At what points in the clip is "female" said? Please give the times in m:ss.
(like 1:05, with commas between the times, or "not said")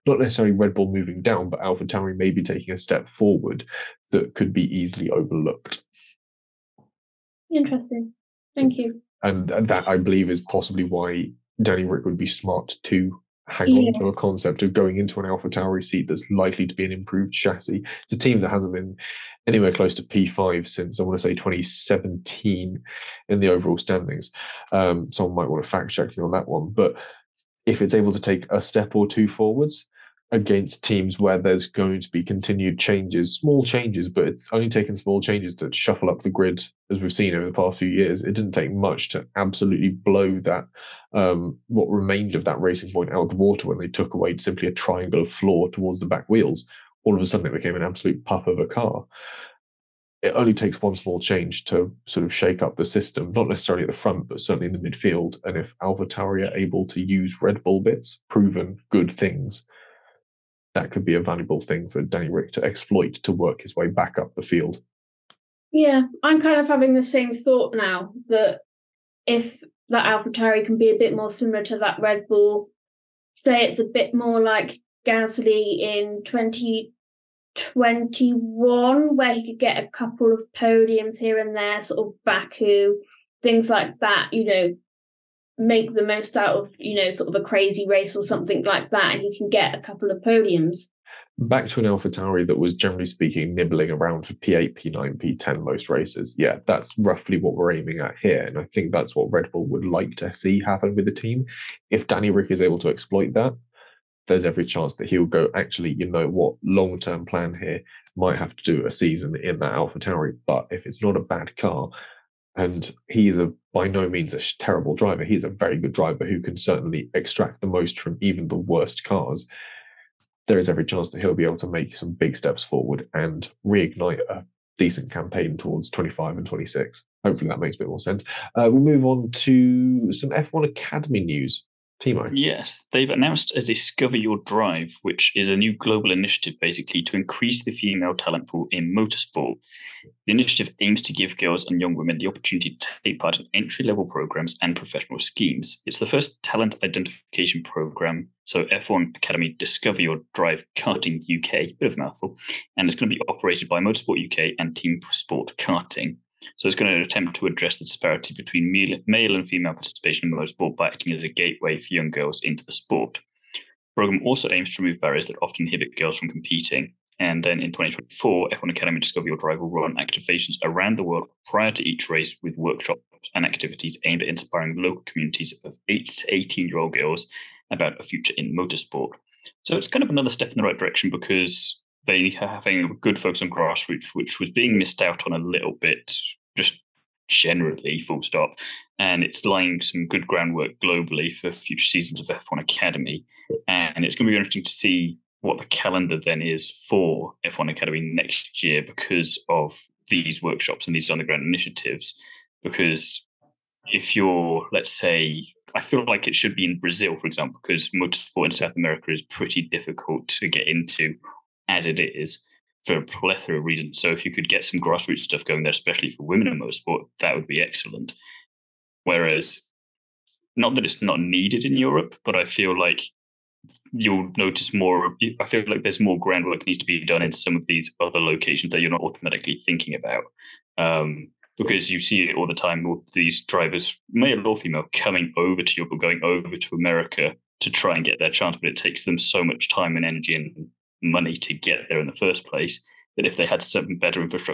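2:17, 2:39, 3:54.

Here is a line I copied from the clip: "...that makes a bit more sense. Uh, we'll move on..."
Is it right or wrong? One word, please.
right.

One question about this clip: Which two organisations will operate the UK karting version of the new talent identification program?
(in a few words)
Motorsport UK and Team Sport Karting.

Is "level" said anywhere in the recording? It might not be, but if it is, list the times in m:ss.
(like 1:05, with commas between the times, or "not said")
2:23.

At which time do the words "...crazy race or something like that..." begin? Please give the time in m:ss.
1:27.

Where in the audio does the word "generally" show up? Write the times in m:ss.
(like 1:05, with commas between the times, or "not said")
1:32, 3:07.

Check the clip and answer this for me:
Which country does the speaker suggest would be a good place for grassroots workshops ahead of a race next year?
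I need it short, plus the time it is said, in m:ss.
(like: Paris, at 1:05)
Brazil, at 3:26.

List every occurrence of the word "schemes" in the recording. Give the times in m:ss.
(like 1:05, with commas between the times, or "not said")
2:25.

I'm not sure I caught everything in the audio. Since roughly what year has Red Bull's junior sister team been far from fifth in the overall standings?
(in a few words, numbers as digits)
2017.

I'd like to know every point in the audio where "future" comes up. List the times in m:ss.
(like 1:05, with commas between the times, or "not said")
2:58, 3:11.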